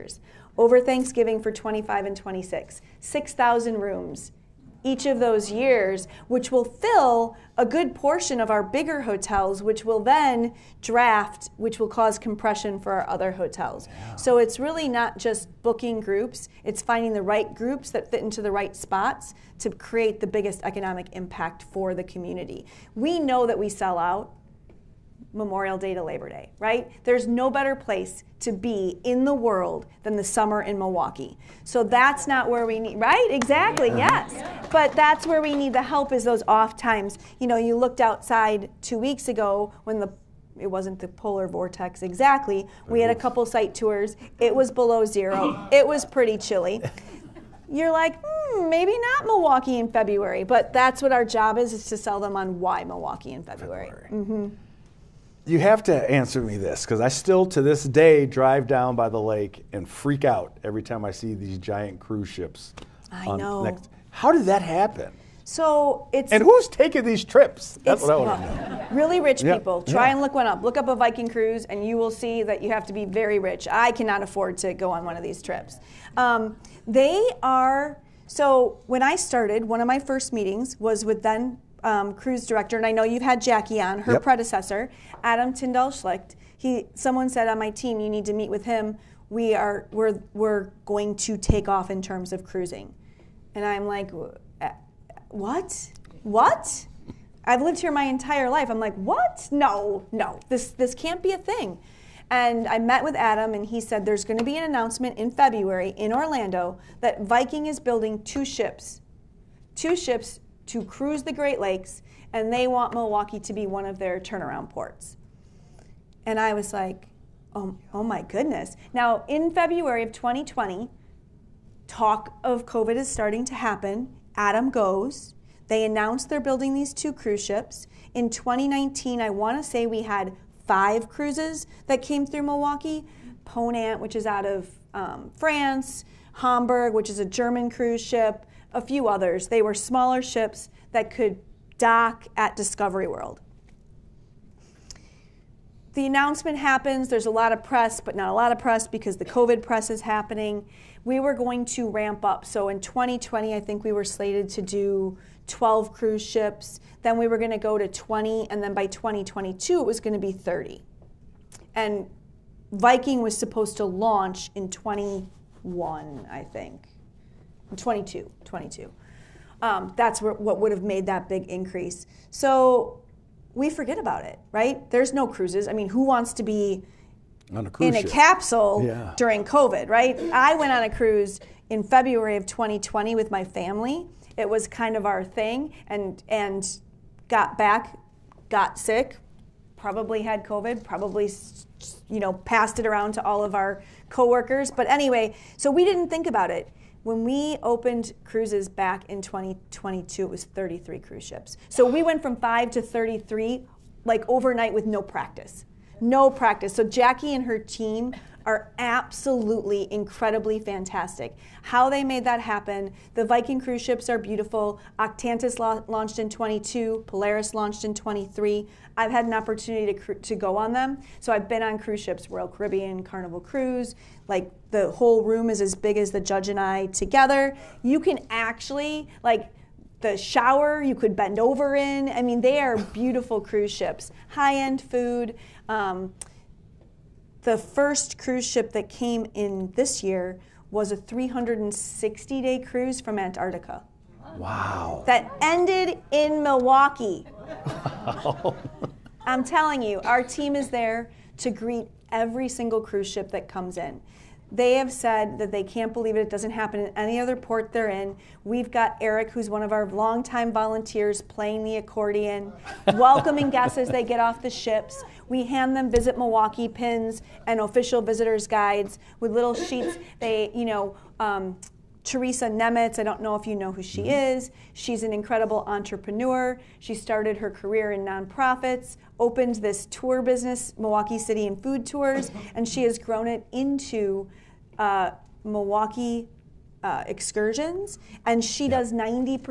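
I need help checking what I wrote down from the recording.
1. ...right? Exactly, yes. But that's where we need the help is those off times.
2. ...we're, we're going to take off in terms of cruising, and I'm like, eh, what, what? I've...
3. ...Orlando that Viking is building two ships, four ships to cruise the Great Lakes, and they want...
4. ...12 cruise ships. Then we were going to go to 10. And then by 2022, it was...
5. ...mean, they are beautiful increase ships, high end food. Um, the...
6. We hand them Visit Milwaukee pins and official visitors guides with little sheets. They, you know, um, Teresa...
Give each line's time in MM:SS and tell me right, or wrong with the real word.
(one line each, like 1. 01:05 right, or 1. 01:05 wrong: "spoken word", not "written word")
1. 00:32 right
2. 01:29 right
3. 01:46 wrong: "two", not "four"
4. 02:35 wrong: "20", not "10"
5. 03:52 wrong: "cruise", not "increase"
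6. 04:25 right.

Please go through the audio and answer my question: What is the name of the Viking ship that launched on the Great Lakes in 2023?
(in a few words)
Polaris.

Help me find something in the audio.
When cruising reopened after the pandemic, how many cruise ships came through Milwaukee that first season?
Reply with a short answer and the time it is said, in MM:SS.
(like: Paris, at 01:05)
33, at 03:20.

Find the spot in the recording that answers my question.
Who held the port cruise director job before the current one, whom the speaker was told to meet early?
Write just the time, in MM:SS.
01:25.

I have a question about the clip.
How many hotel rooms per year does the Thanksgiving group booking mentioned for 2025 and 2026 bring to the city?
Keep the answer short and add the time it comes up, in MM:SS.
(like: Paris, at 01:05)
6,000, at 00:02.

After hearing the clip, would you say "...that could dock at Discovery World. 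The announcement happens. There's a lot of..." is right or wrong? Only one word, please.
right.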